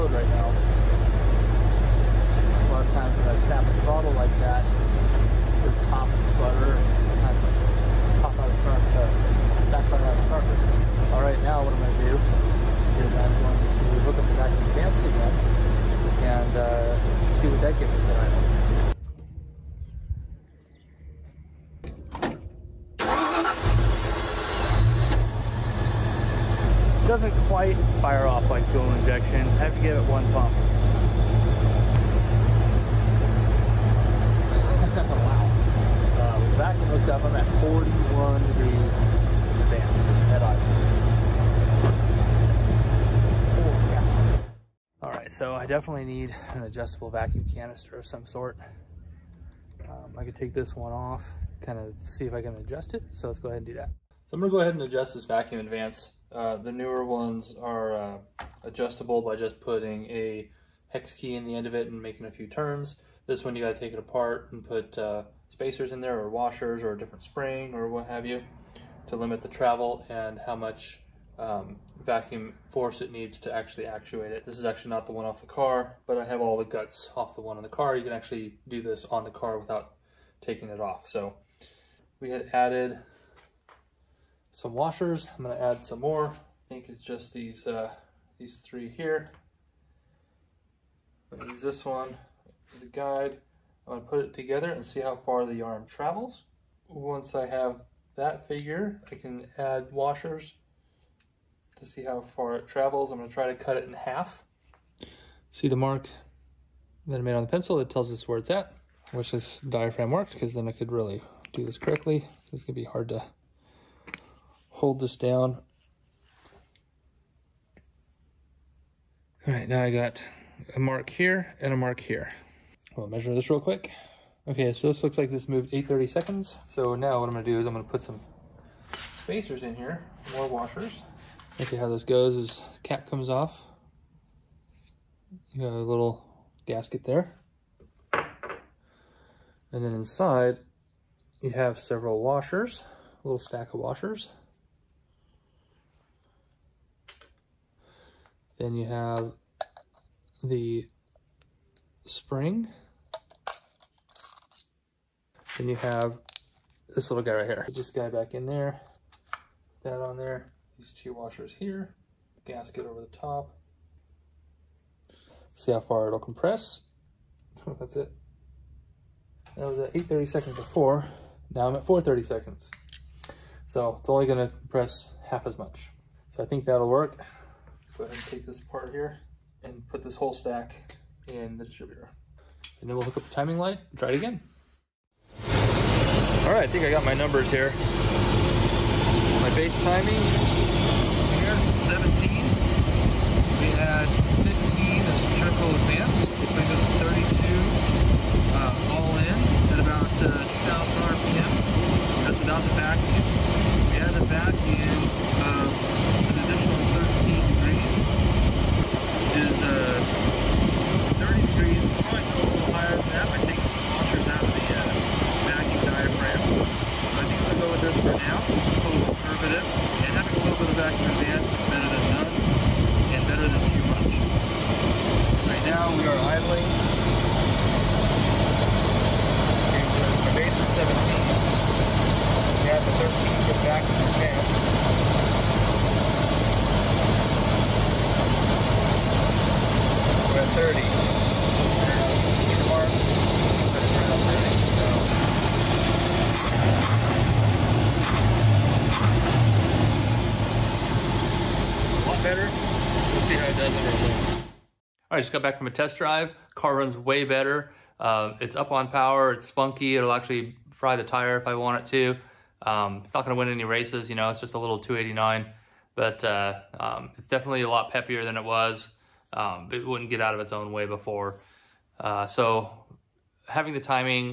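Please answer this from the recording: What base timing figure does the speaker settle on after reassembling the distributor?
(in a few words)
17.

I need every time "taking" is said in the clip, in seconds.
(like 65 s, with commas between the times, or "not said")
80 s.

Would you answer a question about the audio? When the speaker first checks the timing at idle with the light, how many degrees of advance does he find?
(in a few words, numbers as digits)
41 degrees.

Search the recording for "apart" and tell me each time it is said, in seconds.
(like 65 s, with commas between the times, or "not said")
63 s, 178 s.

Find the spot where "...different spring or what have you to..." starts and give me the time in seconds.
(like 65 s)
66 s.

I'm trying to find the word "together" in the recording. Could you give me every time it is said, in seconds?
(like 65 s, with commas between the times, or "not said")
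94 s.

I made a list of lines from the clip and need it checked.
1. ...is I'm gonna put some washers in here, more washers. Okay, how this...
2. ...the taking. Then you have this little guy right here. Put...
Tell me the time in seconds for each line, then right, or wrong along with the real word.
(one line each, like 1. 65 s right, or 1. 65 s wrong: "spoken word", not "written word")
1. 127 s wrong: "spacers", not "washers"
2. 150 s wrong: "spring", not "taking".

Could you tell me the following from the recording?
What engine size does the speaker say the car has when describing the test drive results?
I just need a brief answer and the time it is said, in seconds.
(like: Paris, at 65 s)
289, at 264 s.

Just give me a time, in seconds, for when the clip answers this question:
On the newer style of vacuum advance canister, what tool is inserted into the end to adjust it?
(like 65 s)
60 s.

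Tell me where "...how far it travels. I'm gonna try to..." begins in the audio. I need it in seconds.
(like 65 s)
102 s.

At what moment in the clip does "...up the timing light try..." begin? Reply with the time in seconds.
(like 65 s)
183 s.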